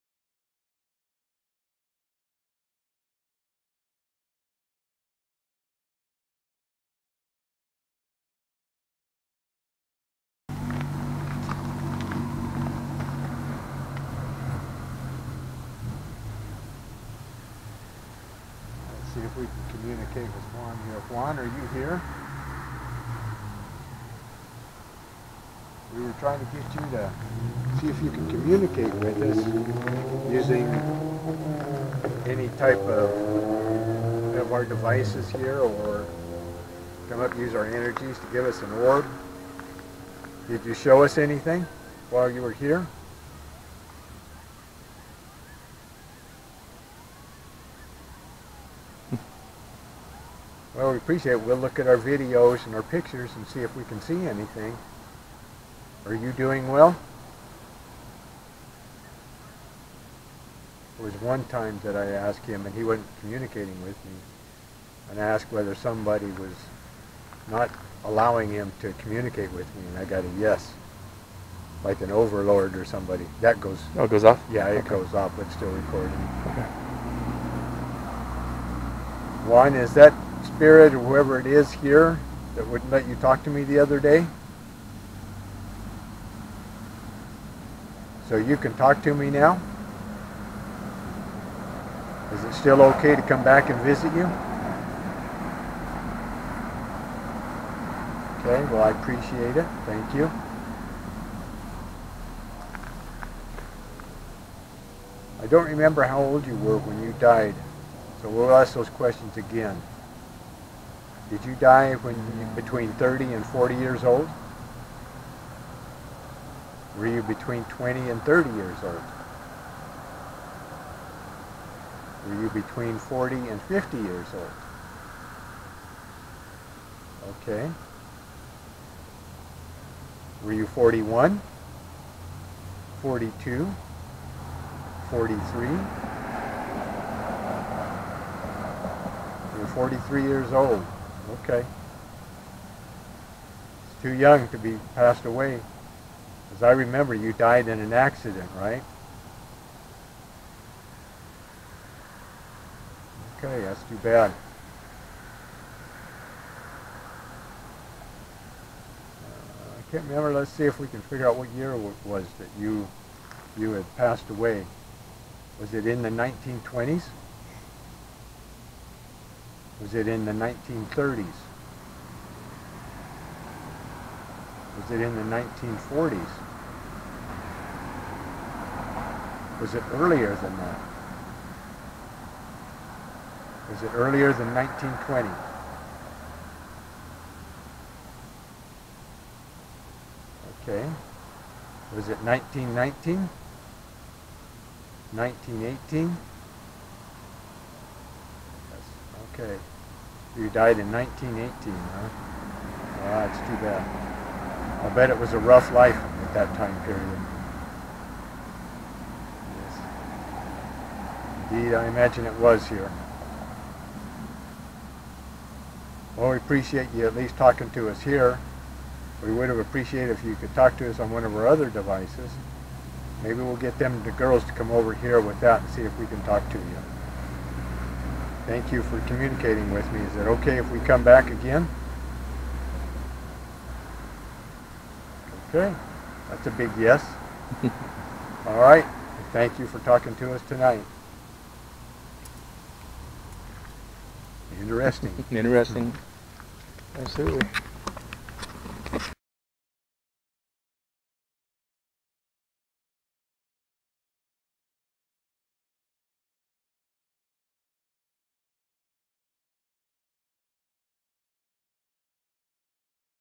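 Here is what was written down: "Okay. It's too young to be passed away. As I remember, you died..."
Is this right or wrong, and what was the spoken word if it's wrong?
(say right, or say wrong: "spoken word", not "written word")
right.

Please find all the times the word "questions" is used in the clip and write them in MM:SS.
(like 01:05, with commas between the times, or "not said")
01:48.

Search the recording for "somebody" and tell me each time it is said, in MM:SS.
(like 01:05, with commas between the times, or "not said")
01:05, 01:12.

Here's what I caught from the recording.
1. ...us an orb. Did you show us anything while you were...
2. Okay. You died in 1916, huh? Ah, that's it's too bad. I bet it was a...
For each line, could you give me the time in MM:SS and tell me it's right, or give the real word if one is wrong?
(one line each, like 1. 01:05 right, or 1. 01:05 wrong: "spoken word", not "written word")
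1. 00:38 right
2. 03:19 wrong: "1918", not "1916".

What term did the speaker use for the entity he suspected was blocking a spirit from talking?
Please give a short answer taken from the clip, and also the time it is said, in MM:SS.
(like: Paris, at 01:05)
overlord, at 01:12.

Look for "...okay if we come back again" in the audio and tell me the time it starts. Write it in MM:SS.
03:50.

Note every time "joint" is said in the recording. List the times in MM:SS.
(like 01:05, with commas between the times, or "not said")
not said.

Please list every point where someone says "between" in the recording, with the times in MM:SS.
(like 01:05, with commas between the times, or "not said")
01:52, 01:57, 02:02.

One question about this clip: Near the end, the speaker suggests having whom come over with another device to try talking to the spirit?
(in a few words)
the girls.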